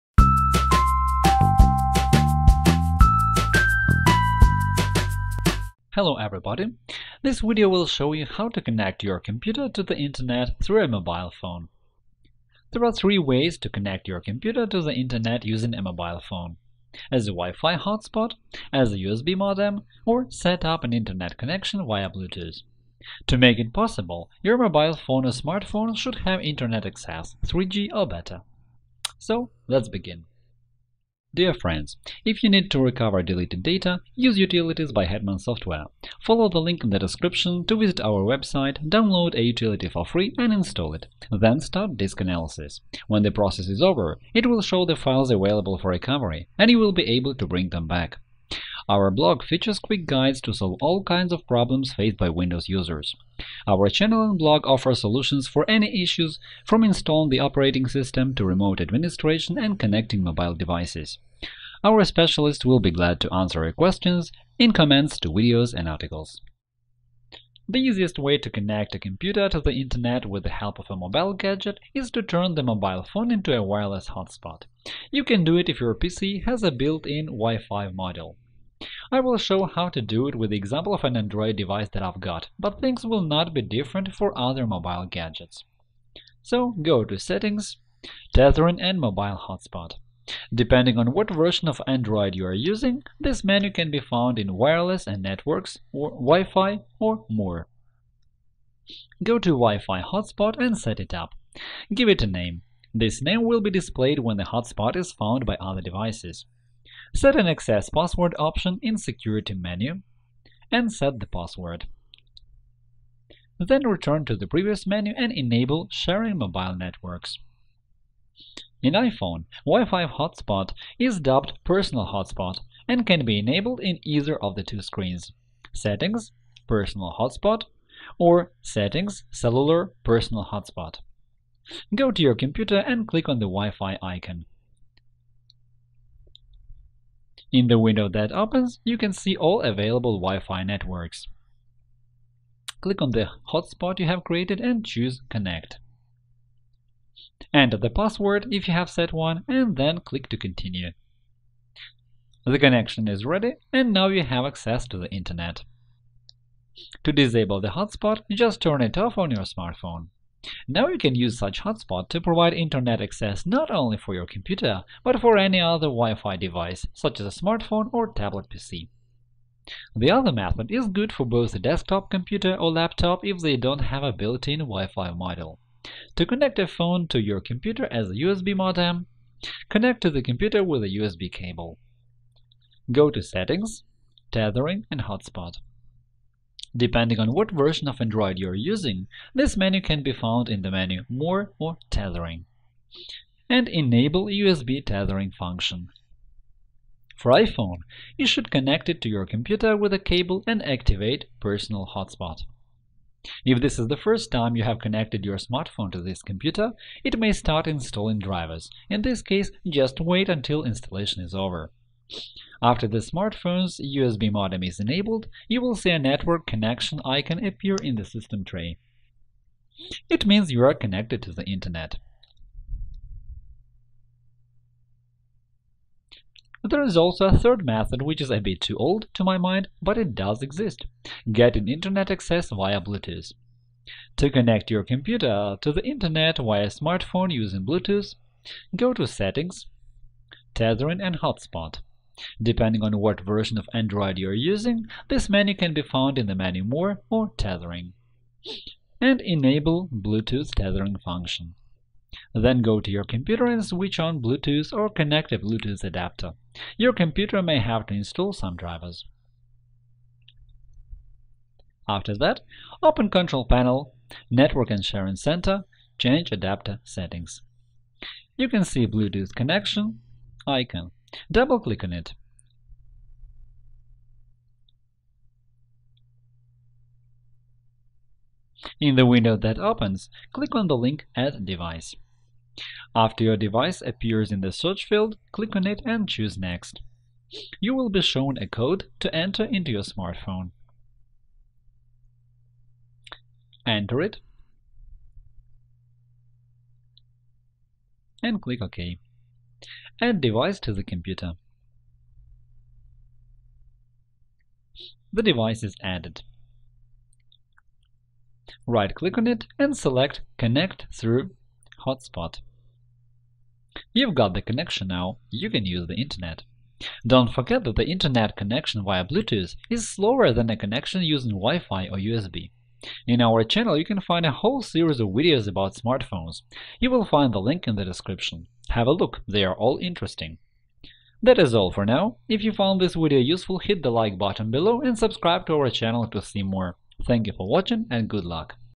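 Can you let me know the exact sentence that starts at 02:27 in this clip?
Enter the password if you have set one and then click to continue.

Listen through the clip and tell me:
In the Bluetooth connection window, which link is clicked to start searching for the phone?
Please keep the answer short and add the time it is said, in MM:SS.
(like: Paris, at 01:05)
Add device, at 04:41.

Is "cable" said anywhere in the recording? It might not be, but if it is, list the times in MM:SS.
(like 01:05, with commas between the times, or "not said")
03:01, 03:19.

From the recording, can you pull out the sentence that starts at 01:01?
Our specialists will be glad to answer your questions in comments to videos and articles.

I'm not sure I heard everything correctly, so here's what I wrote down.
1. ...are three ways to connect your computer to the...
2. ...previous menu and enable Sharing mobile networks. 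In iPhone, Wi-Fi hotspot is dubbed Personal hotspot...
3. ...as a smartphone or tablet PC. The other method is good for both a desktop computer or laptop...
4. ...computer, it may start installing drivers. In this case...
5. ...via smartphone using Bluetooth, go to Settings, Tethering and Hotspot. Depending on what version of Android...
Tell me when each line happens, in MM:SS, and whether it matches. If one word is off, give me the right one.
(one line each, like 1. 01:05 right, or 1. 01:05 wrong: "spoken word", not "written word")
1. 00:12 right
2. 01:54 right
3. 02:47 right
4. 03:26 right
5. 03:56 right.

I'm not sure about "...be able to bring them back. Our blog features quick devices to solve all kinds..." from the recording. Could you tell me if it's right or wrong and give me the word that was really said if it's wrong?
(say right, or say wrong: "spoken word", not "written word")
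wrong: "guides", not "devices".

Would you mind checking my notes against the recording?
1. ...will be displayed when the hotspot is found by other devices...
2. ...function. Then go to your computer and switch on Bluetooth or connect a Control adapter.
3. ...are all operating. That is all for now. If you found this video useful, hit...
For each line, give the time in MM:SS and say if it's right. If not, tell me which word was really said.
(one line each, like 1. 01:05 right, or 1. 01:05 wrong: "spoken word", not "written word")
1. 01:43 right
2. 04:10 wrong: "Bluetooth", not "Control"
3. 05:29 wrong: "interesting", not "operating".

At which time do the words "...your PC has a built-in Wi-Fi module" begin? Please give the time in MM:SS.
01:15.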